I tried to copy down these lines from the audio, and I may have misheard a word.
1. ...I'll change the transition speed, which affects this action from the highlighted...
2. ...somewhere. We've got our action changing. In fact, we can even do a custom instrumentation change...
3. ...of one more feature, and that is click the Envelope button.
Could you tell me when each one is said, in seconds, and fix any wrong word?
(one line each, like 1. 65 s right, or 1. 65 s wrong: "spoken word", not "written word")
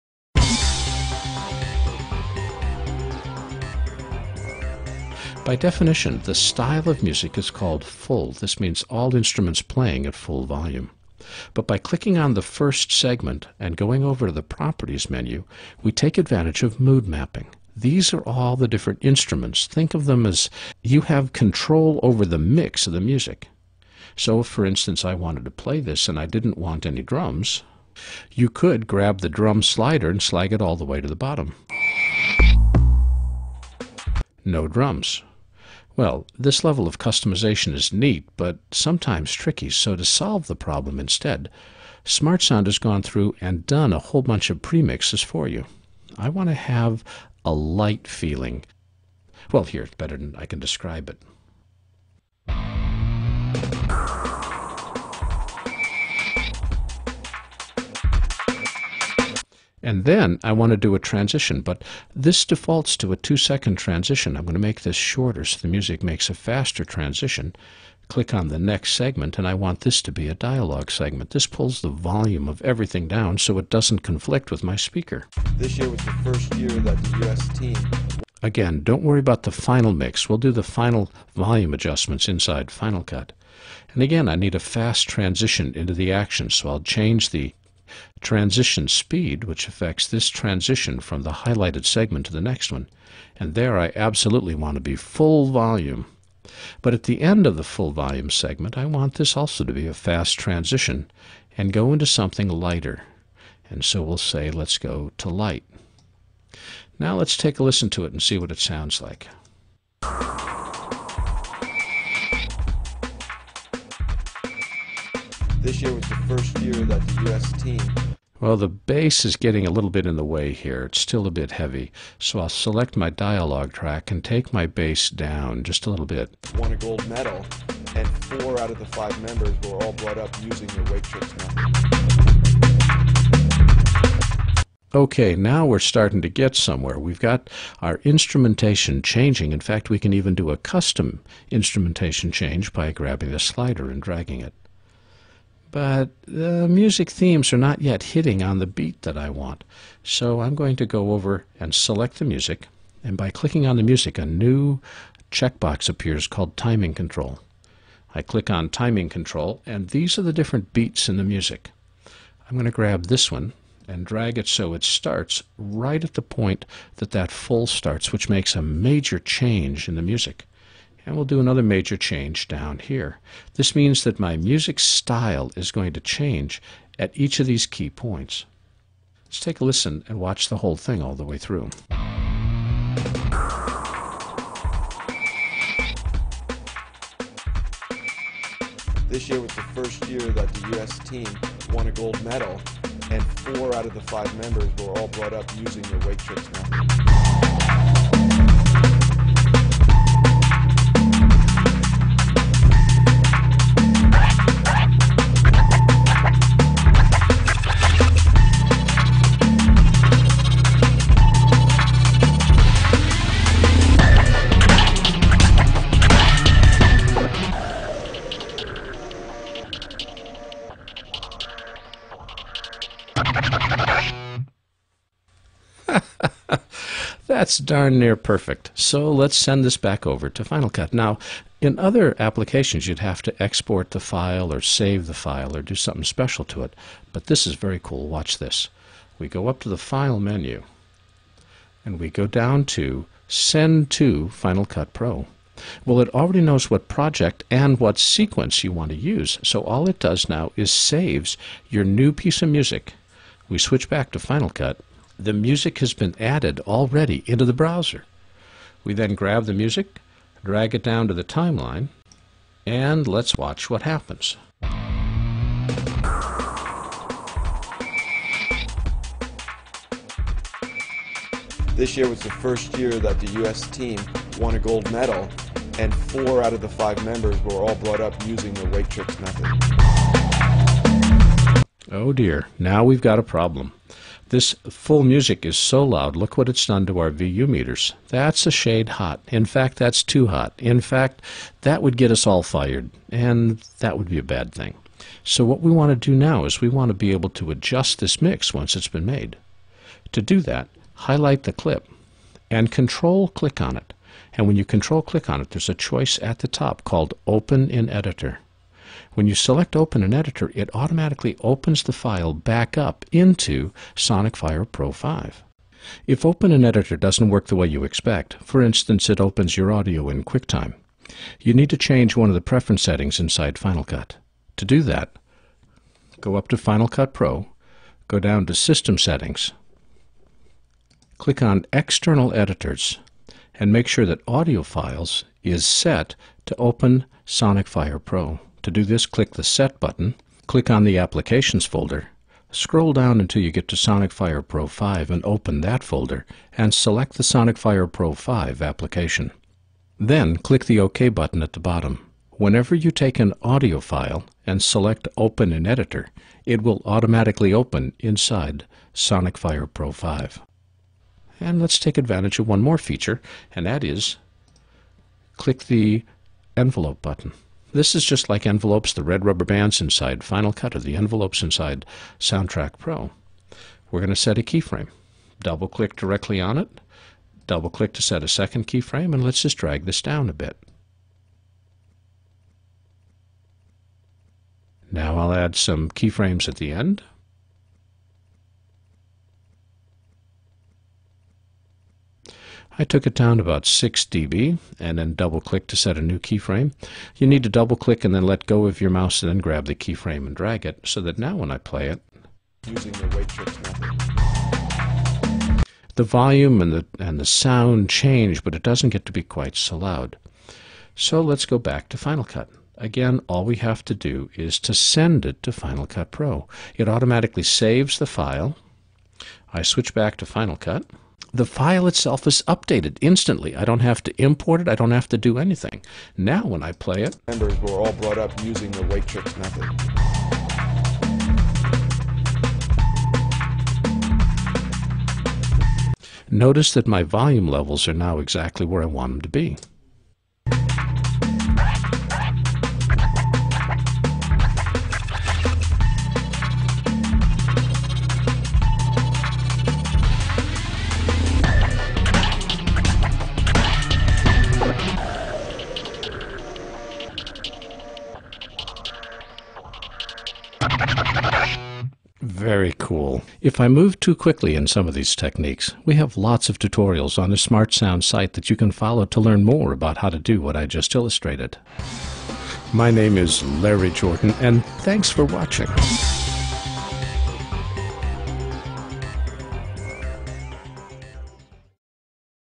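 1. 86 s wrong: "transition", not "action"
2. 136 s wrong: "instrumentation", not "action"
3. 362 s right.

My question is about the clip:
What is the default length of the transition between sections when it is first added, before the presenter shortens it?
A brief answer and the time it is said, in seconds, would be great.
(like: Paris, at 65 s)
2 seconds, at 63 s.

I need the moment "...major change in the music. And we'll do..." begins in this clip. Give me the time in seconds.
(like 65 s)
168 s.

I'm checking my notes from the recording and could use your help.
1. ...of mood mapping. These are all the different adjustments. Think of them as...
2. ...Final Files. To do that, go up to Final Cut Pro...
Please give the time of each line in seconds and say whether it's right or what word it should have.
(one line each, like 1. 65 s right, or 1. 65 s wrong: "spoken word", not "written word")
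1. 16 s wrong: "instruments", not "adjustments"
2. 323 s wrong: "Cut", not "Files".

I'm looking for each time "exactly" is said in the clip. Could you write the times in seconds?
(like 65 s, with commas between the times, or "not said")
438 s.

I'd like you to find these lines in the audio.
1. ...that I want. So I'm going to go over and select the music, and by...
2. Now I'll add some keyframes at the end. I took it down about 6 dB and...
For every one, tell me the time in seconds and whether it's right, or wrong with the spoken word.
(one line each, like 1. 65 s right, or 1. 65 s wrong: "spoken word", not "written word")
1. 149 s right
2. 384 s right.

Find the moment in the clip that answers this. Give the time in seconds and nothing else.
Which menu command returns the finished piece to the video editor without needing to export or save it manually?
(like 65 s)
243 s.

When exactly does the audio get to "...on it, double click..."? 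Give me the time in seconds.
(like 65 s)
376 s.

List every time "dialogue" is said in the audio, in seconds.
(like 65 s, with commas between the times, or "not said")
70 s, 123 s.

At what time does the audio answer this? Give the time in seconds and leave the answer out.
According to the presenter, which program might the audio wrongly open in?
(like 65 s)
320 s.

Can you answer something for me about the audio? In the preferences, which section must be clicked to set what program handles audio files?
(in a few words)
External Editors.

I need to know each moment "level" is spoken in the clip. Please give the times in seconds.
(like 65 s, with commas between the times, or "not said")
36 s, 437 s.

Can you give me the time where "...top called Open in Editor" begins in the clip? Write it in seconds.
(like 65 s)
306 s.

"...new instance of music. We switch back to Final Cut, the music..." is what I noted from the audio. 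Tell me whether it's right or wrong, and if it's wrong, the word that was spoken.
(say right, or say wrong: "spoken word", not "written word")
wrong: "piece", not "instance".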